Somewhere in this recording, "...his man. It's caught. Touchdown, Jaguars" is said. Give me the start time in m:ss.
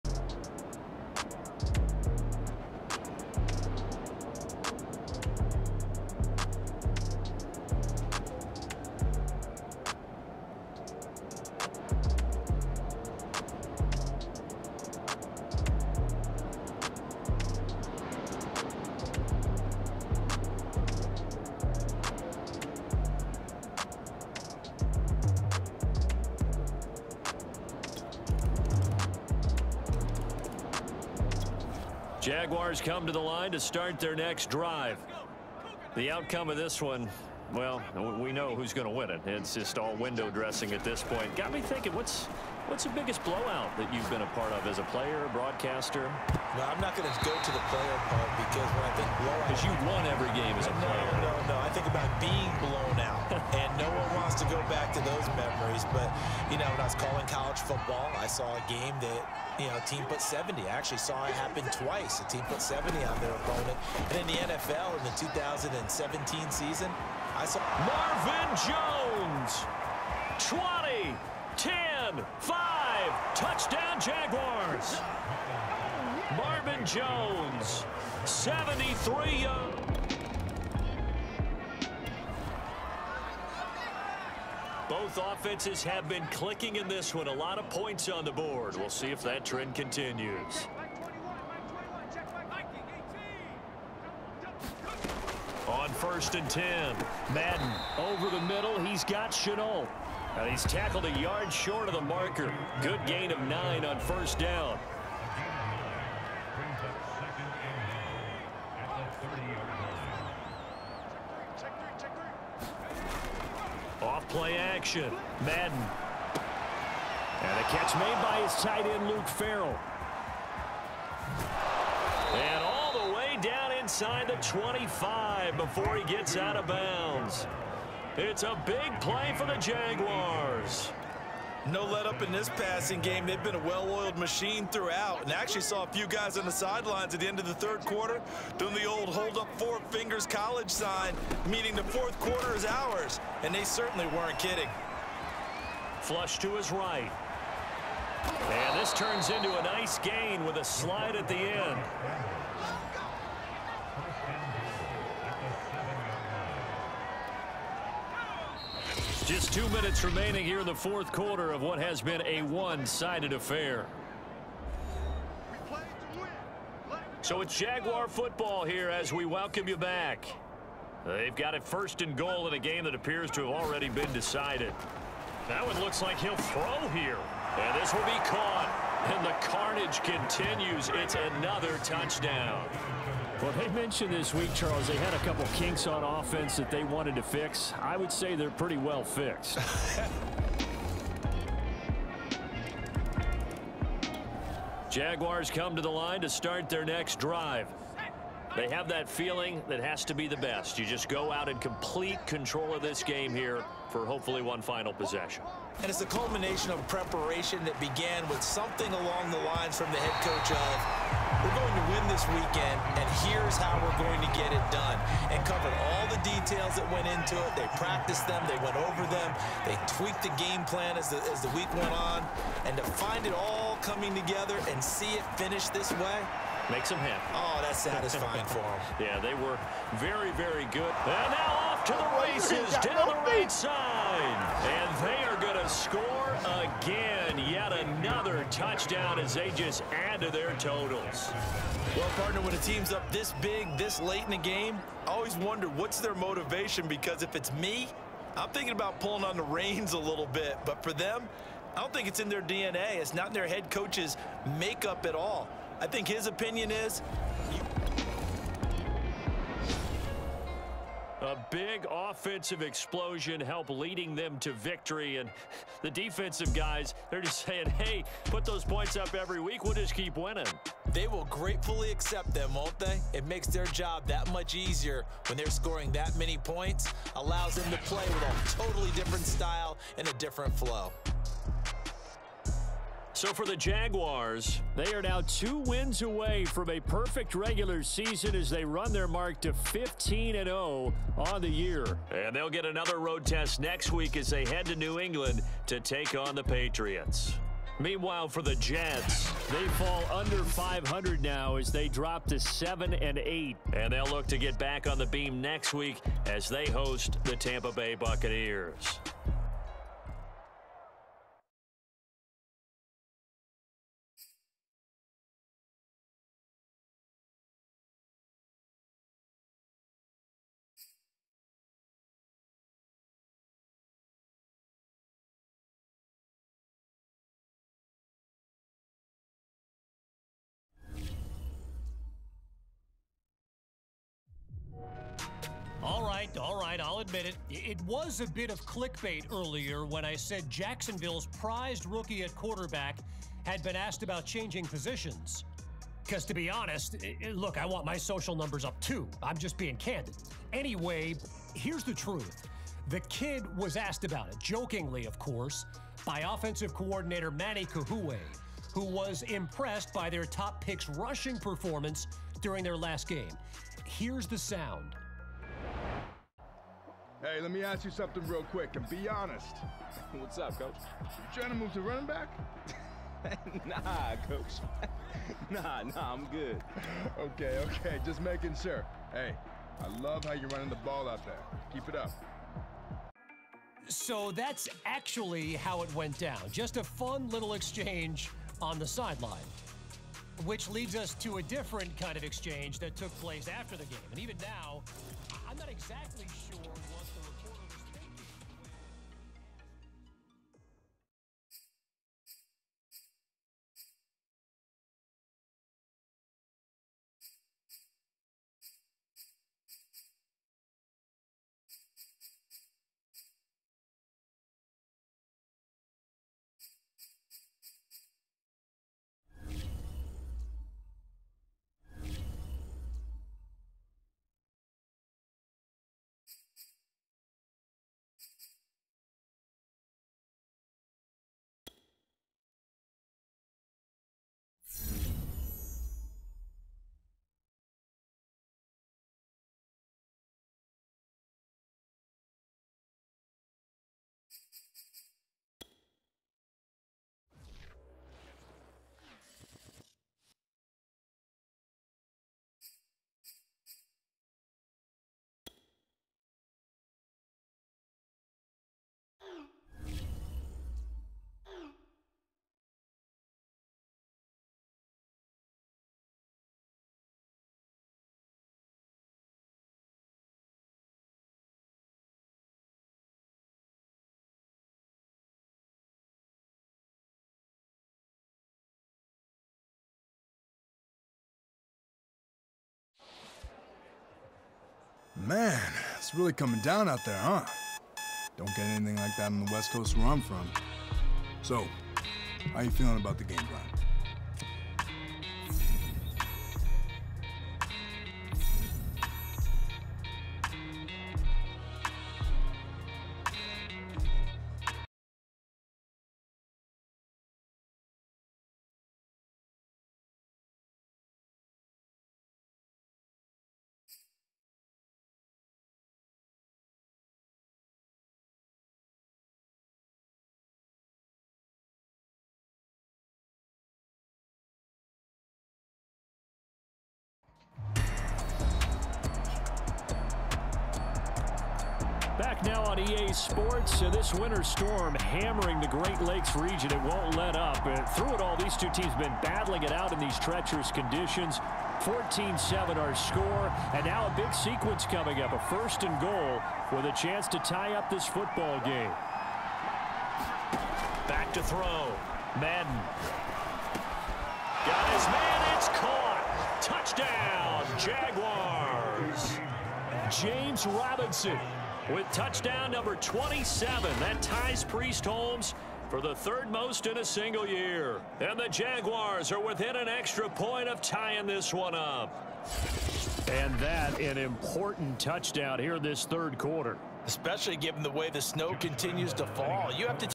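9:14.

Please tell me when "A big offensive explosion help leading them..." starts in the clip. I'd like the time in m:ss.
4:21.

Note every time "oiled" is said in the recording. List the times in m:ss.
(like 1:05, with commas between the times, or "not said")
2:13.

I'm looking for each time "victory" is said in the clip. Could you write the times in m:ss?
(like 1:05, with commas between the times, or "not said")
4:24.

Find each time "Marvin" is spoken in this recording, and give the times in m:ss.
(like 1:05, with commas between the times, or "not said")
1:07, 1:16.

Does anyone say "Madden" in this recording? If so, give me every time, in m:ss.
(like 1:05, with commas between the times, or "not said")
1:37, 1:55, 9:12.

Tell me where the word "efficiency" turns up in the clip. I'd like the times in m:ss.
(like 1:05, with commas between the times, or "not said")
not said.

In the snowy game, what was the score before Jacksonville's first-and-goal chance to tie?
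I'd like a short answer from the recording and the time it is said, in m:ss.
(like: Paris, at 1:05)
14-7, at 9:01.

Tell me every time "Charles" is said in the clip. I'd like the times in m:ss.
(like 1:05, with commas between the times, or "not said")
3:04.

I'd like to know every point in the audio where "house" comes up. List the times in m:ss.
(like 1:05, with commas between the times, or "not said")
not said.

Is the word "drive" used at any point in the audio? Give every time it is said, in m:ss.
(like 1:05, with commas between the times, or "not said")
0:34, 3:17.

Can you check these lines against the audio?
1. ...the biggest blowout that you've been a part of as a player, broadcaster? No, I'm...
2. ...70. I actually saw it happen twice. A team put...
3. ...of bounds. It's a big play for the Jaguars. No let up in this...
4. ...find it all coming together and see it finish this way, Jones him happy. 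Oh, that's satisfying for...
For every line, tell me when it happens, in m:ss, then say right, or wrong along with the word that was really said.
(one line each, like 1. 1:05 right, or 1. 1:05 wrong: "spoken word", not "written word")
1. 0:42 right
2. 1:00 right
3. 2:06 right
4. 3:42 wrong: "Makes", not "Jones".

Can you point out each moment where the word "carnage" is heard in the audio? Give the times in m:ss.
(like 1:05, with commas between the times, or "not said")
2:59.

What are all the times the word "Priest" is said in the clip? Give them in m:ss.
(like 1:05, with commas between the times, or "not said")
9:24.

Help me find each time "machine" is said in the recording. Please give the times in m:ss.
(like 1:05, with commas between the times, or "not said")
2:14.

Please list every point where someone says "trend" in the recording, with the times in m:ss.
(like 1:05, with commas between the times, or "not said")
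1:29.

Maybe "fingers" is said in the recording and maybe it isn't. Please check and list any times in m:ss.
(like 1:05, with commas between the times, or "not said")
2:19.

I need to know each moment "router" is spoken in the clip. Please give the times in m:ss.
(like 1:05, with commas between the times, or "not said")
not said.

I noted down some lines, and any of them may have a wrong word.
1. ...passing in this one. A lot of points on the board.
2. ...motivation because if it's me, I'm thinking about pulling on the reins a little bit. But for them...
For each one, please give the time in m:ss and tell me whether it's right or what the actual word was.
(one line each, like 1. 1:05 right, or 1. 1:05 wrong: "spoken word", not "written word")
1. 1:26 wrong: "clicking", not "passing"
2. 4:06 right.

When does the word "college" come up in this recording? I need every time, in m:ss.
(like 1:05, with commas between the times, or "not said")
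0:57, 2:20.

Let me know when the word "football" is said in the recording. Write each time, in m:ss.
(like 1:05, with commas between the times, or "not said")
0:57, 2:48, 9:08.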